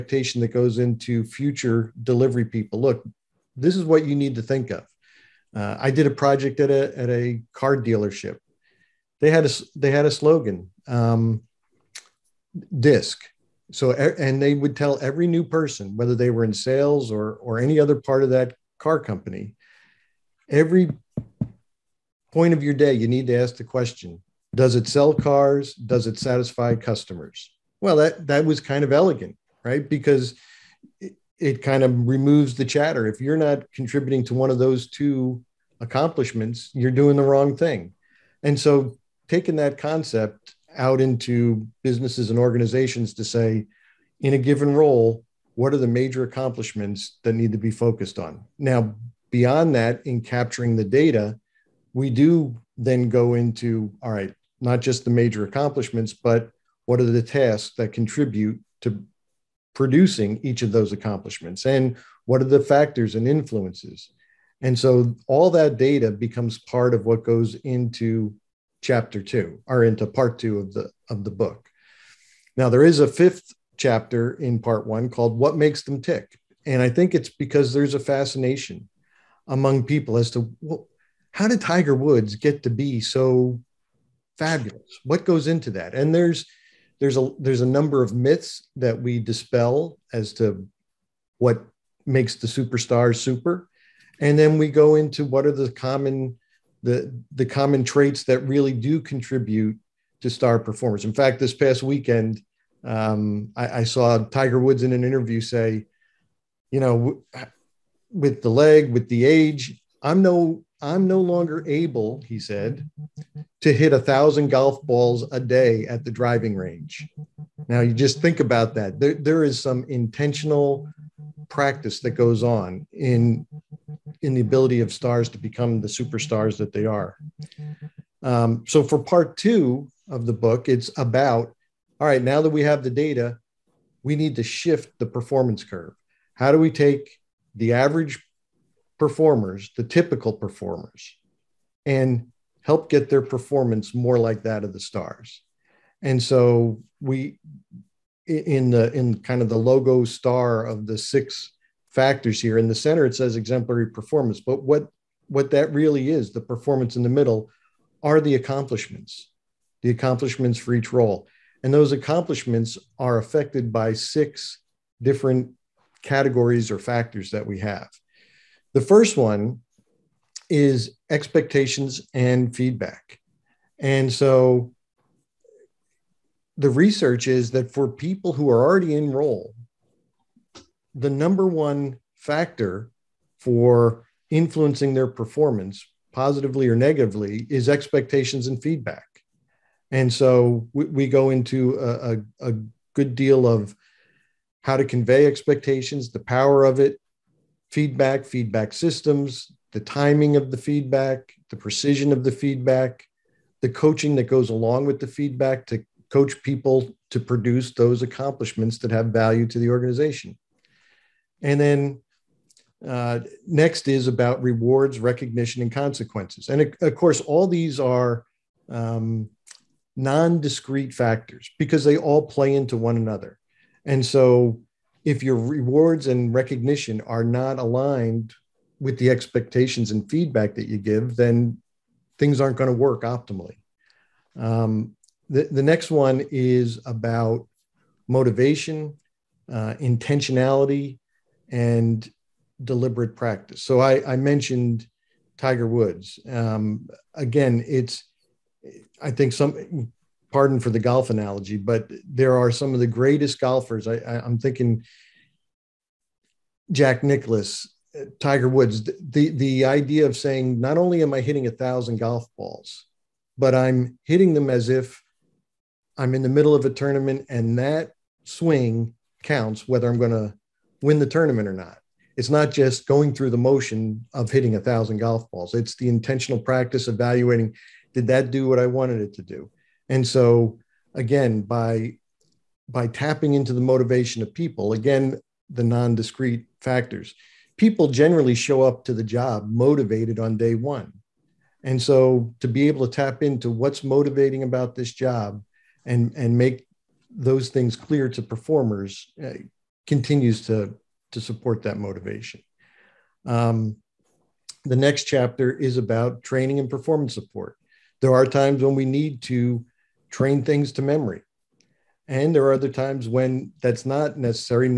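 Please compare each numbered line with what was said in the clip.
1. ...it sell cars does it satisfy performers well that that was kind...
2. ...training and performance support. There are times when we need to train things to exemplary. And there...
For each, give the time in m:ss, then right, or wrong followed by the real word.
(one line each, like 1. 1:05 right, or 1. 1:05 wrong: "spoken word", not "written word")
1. 0:24 wrong: "customers", not "performers"
2. 5:06 wrong: "memory", not "exemplary".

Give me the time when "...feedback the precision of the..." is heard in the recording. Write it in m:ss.
3:20.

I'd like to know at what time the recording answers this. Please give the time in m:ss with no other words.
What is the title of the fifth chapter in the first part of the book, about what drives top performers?
1:15.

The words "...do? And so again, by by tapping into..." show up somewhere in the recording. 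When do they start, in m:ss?
4:39.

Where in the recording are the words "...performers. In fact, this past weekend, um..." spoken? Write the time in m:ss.
1:40.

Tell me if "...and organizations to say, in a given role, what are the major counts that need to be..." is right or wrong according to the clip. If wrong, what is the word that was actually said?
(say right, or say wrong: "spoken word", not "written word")
wrong: "accomplishments", not "counts".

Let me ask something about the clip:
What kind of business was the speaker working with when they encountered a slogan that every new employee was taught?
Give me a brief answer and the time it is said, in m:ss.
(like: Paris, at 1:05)
Car dealership, at 0:07.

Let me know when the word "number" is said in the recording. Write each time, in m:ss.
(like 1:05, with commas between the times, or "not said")
1:27, 3:01.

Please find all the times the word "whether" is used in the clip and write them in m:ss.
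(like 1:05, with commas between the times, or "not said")
0:15, 4:29.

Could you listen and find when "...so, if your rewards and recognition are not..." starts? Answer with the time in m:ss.
3:44.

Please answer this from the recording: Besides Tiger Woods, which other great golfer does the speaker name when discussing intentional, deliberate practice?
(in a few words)
Jack Nicklaus.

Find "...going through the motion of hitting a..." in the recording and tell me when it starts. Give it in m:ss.
4:32.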